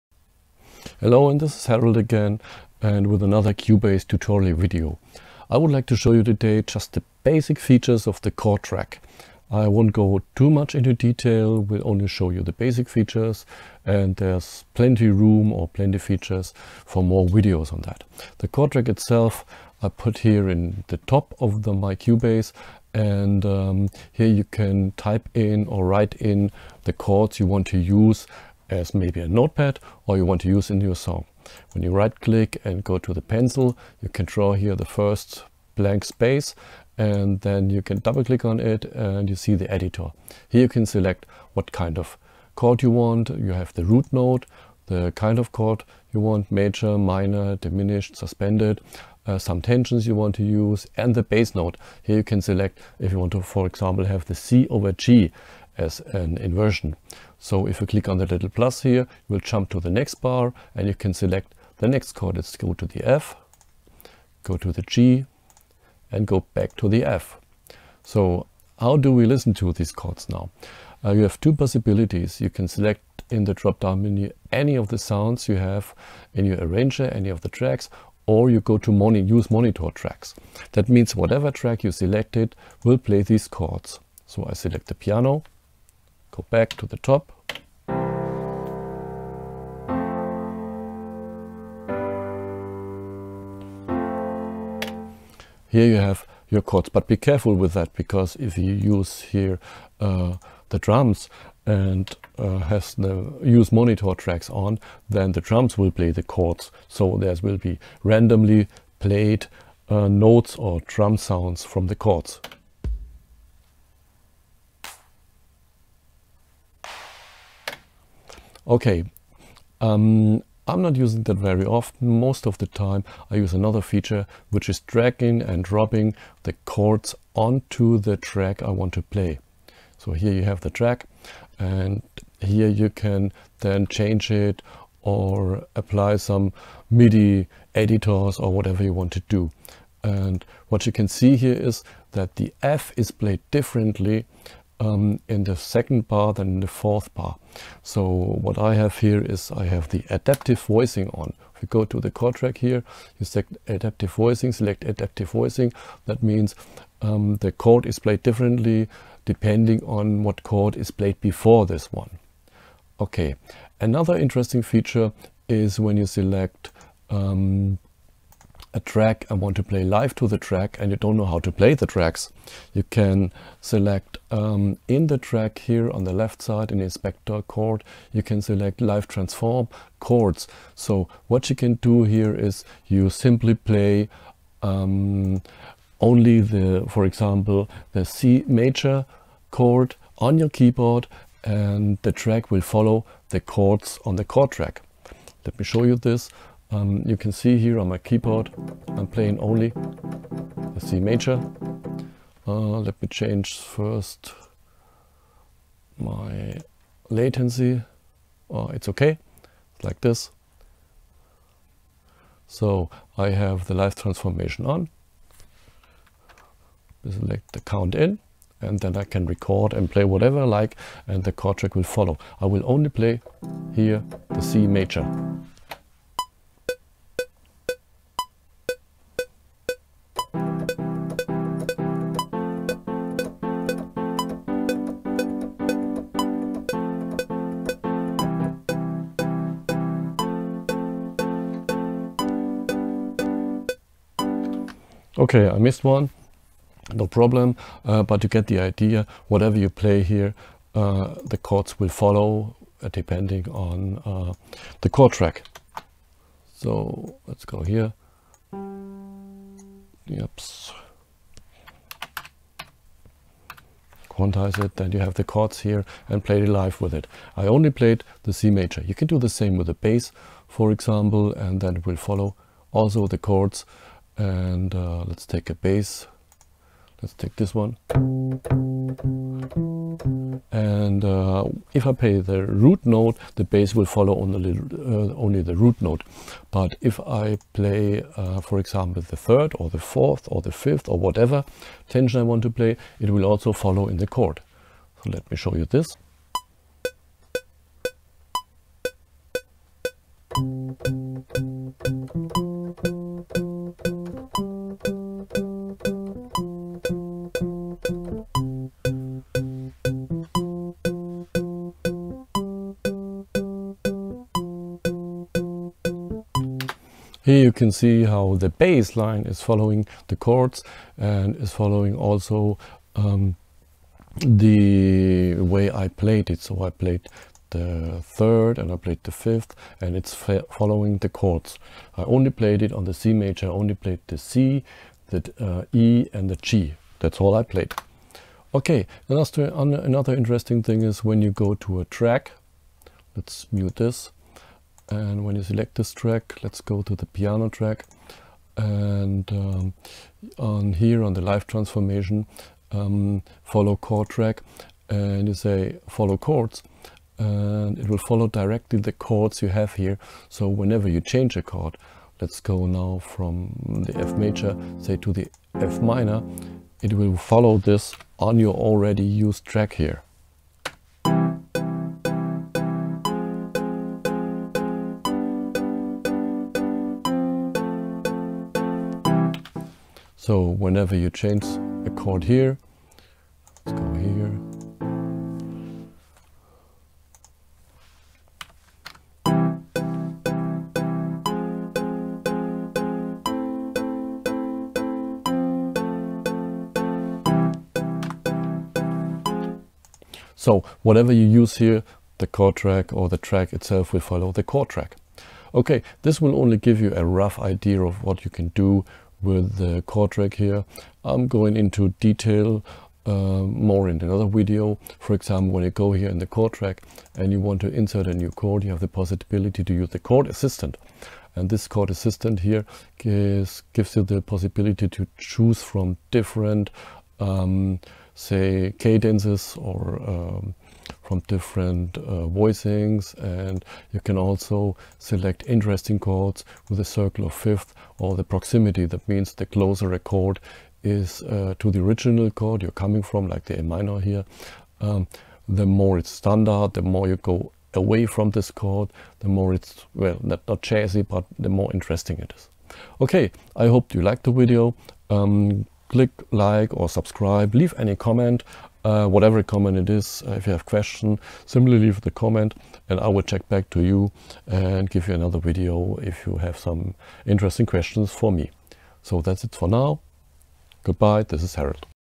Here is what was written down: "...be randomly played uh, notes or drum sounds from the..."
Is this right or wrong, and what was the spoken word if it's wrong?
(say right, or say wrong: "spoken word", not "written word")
right.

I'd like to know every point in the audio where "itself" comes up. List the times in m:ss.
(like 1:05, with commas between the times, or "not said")
0:18, 6:43.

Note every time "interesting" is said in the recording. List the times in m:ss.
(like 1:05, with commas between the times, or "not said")
2:44, 5:40, 7:15, 7:31, 7:47.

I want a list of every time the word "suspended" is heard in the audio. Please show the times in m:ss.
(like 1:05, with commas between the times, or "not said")
0:48.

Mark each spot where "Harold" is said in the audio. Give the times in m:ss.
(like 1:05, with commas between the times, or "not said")
0:01, 7:51.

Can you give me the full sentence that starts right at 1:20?
That means whatever track you selected will play these chords.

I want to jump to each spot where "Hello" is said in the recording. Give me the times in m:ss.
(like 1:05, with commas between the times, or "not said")
0:01.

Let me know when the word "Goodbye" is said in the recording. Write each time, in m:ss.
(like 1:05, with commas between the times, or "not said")
7:50.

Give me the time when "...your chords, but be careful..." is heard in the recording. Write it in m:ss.
1:36.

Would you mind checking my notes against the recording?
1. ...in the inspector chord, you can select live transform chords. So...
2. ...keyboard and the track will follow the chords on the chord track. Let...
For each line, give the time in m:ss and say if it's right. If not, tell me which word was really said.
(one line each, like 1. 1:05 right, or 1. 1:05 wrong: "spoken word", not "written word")
1. 2:56 right
2. 3:10 right.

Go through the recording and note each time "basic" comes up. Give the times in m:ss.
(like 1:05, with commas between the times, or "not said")
0:07, 0:12.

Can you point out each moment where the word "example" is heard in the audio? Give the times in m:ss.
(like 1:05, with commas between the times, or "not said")
0:53, 3:07, 4:30, 4:48, 6:55.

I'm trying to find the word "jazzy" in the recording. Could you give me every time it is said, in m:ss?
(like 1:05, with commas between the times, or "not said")
7:30.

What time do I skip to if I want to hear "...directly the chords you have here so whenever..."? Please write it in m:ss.
5:58.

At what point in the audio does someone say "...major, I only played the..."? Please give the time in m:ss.
5:33.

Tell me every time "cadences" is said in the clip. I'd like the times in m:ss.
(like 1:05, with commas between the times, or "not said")
7:08.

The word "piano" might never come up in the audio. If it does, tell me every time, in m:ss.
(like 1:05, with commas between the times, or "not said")
1:24, 5:47.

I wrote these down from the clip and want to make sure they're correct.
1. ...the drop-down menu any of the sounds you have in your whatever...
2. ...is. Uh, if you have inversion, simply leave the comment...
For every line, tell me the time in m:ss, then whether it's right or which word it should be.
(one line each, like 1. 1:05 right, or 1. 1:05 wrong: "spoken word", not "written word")
1. 1:13 wrong: "arranger", not "whatever"
2. 7:39 wrong: "question", not "inversion".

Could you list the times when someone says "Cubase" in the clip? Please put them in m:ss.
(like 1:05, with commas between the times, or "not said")
0:03, 0:21.